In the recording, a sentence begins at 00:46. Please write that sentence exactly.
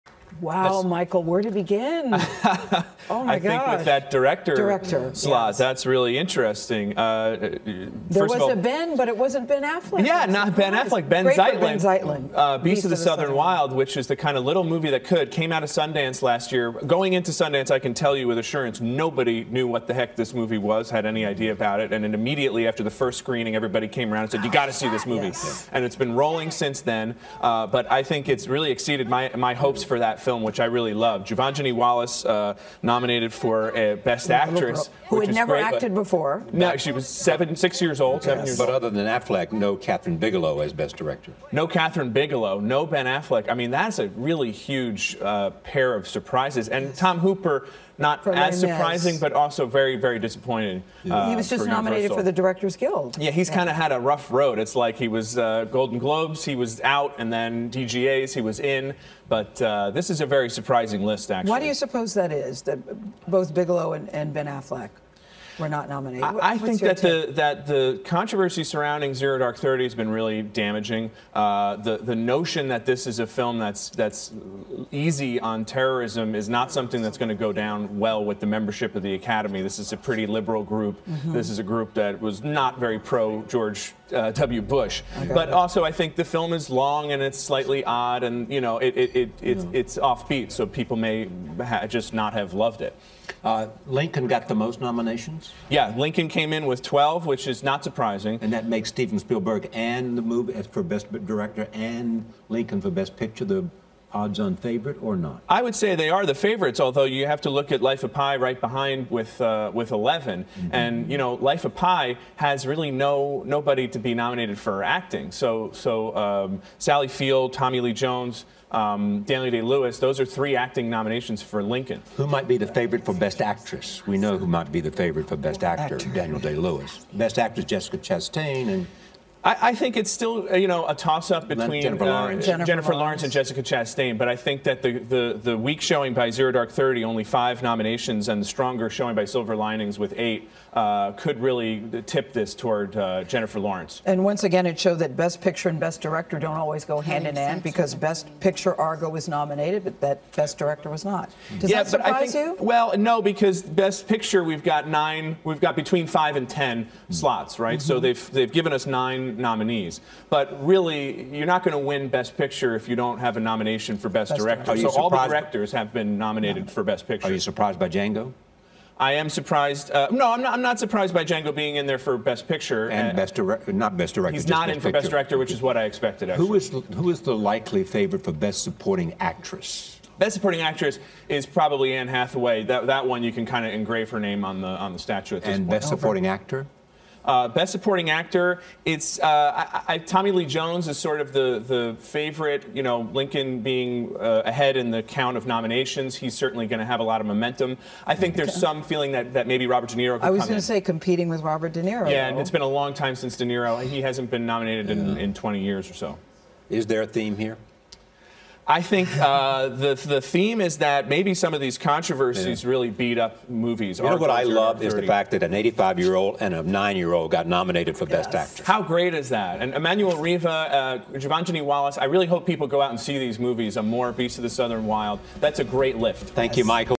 And Tom Hooper not as surprising, but also very, very disappointing.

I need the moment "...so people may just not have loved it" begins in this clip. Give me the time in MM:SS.
01:30.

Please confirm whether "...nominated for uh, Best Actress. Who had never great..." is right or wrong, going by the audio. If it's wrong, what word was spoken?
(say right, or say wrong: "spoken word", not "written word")
right.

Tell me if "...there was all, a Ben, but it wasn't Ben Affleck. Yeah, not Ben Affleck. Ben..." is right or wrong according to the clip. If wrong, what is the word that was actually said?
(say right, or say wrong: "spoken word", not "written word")
right.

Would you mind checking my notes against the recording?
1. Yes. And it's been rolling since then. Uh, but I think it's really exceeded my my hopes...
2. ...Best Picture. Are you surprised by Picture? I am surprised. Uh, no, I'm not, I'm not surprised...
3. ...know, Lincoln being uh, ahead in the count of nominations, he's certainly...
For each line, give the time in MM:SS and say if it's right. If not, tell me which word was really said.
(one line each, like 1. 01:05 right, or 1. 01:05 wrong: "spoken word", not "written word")
1. 00:25 right
2. 02:46 wrong: "Django", not "Picture"
3. 03:12 right.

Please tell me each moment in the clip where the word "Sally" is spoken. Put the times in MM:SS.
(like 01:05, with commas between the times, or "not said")
01:56.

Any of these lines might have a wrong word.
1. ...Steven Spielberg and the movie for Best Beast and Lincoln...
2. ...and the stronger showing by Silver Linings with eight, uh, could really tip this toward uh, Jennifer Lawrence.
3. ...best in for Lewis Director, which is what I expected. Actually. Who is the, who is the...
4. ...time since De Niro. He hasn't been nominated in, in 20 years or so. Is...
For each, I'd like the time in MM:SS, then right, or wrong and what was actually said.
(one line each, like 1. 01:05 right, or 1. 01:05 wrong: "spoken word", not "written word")
1. 01:38 wrong: "Director", not "Beast"
2. 02:18 right
3. 02:54 wrong: "Best", not "Lewis"
4. 03:22 right.